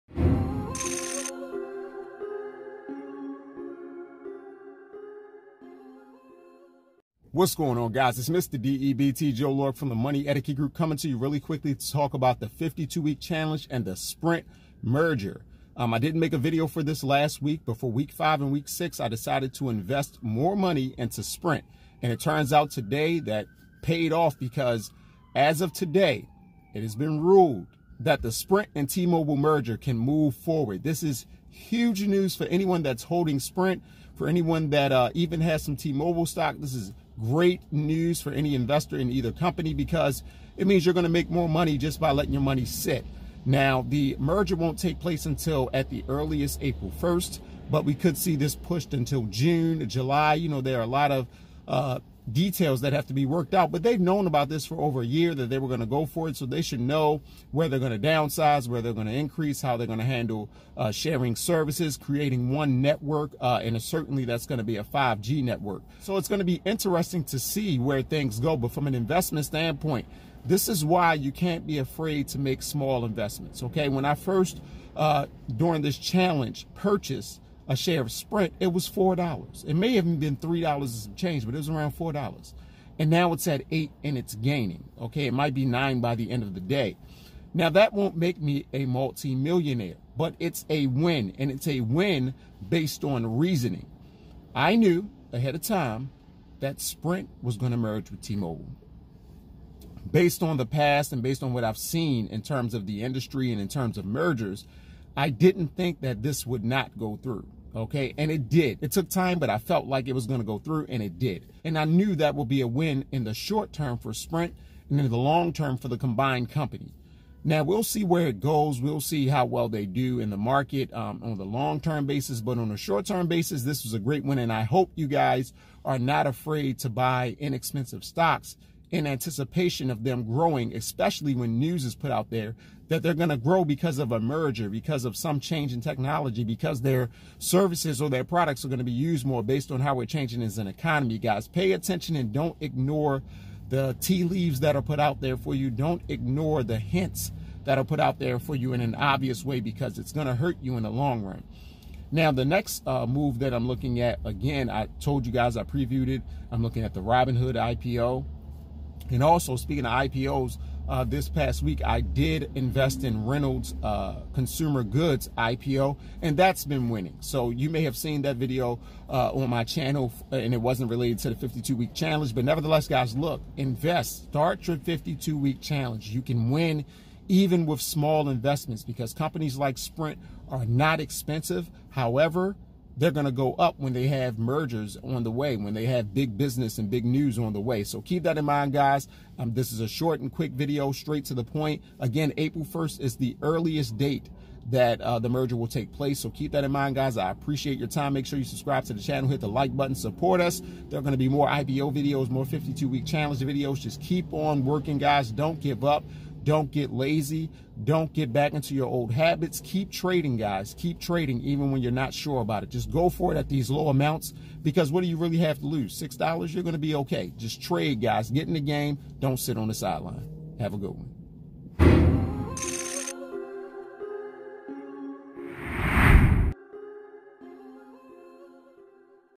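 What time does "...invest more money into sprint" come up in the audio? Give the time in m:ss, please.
0:19.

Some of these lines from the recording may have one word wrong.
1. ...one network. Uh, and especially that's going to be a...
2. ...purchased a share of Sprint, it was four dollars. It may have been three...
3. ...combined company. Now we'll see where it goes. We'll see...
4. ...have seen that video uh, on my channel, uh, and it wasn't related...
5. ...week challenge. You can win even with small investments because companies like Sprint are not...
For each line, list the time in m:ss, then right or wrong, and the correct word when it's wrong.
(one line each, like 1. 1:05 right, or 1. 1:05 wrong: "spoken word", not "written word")
1. 1:02 wrong: "certainly", not "especially"
2. 1:16 right
3. 1:55 right
4. 2:47 right
5. 2:55 right.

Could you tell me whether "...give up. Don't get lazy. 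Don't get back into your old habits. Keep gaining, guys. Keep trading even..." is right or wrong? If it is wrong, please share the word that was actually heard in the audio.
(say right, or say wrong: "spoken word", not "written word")
wrong: "trading", not "gaining".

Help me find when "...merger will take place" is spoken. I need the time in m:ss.
3:15.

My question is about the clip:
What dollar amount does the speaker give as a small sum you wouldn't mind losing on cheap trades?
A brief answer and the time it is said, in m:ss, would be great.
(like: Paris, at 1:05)
$6, at 3:36.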